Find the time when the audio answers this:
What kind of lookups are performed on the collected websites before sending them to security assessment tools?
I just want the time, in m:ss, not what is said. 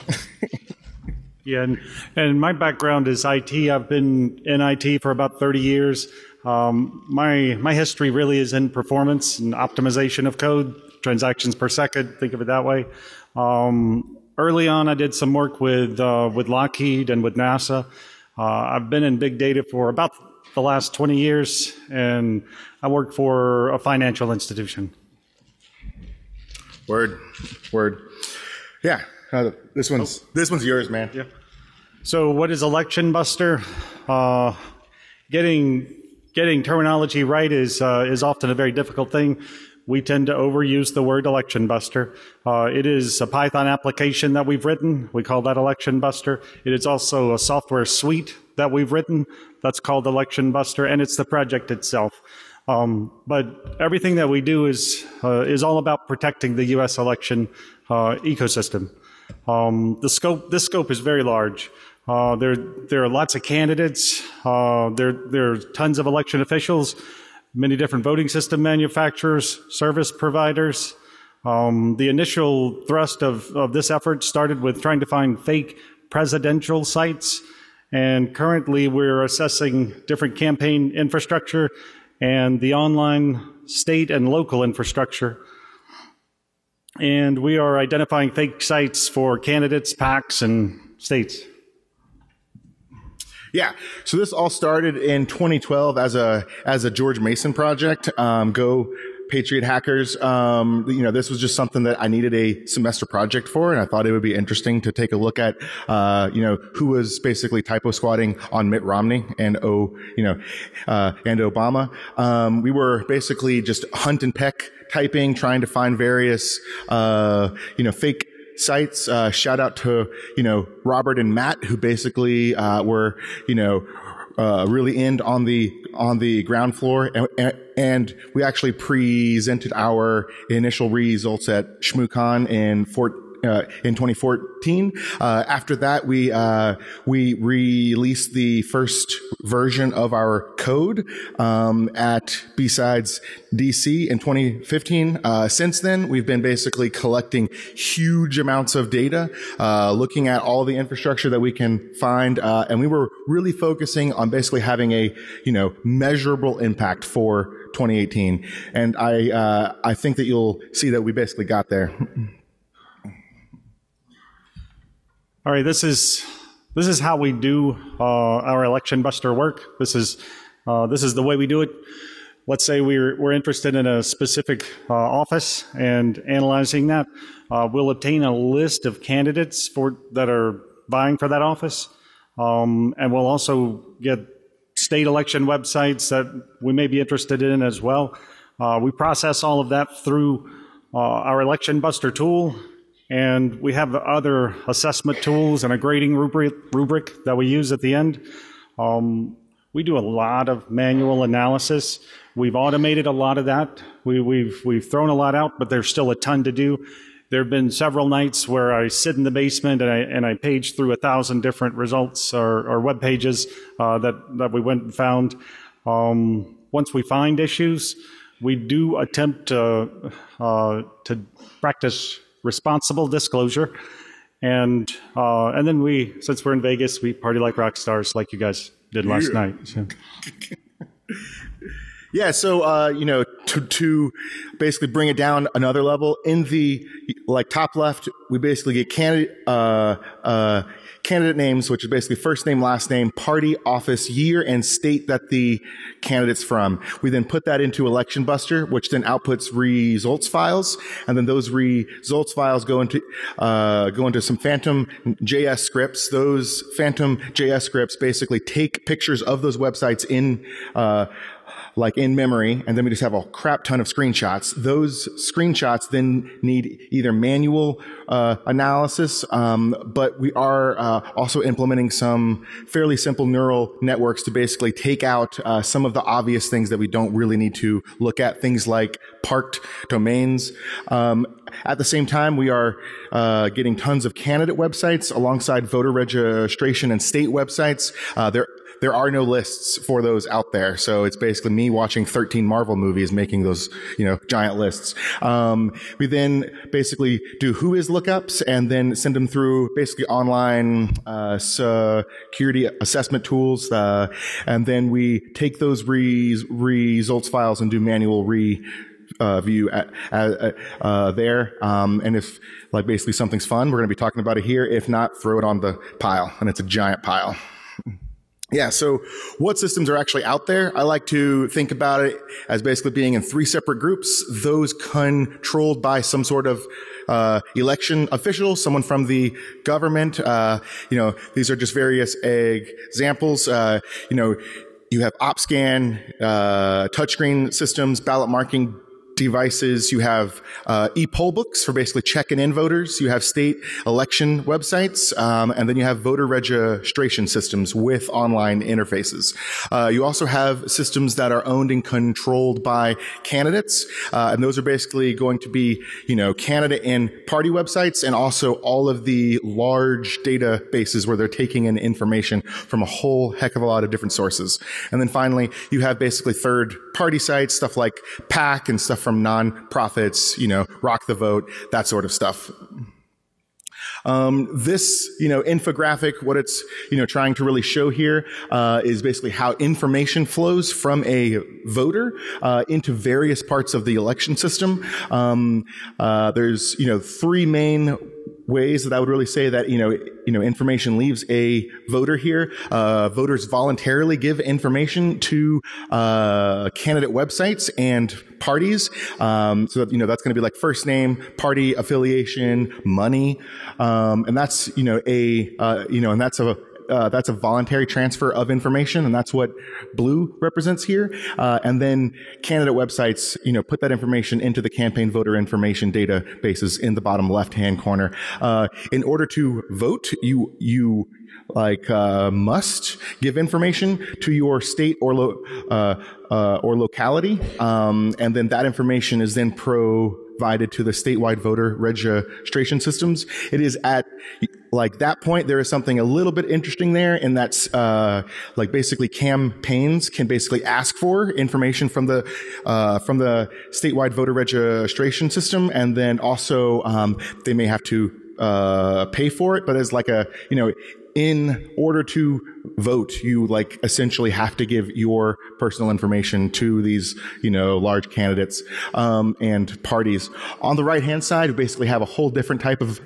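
4:57.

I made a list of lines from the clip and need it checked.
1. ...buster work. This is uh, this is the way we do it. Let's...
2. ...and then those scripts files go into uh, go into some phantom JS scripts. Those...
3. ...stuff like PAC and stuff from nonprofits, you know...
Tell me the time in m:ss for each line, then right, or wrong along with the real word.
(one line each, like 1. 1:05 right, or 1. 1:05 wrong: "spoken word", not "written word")
1. 2:49 right
2. 4:11 wrong: "results", not "scripts"
3. 6:07 right.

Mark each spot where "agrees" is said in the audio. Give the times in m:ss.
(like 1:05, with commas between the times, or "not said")
not said.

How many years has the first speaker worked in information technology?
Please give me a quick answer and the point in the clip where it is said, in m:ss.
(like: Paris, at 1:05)
30 years, at 0:05.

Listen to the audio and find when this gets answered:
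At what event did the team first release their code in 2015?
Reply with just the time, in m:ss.
2:22.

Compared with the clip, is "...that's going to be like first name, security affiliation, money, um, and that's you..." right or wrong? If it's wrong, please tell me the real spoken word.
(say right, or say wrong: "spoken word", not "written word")
wrong: "party", not "security".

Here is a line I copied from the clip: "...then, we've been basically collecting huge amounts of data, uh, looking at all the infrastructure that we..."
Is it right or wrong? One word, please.
right.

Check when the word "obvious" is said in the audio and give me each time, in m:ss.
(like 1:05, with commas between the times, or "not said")
4:36.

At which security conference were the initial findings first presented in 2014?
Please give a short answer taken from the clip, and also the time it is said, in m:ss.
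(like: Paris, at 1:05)
ShmooCon, at 2:11.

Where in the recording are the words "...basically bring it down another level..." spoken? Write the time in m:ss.
3:54.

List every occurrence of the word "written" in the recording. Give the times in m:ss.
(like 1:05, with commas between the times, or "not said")
0:44, 0:48.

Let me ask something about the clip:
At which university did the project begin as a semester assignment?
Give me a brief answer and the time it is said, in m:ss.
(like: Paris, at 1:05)
George Mason, at 1:36.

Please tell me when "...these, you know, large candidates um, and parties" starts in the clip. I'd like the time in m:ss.
7:36.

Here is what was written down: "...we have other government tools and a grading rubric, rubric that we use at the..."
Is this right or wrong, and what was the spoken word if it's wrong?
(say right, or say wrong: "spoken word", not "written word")
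wrong: "assessment", not "government".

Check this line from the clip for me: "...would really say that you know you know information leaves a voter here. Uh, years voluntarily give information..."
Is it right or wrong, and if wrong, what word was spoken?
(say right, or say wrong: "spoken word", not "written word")
wrong: "voters", not "years".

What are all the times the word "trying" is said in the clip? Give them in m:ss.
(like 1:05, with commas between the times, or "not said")
1:14, 1:55, 6:17.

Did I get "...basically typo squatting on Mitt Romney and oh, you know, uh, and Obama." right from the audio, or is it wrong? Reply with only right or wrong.
right.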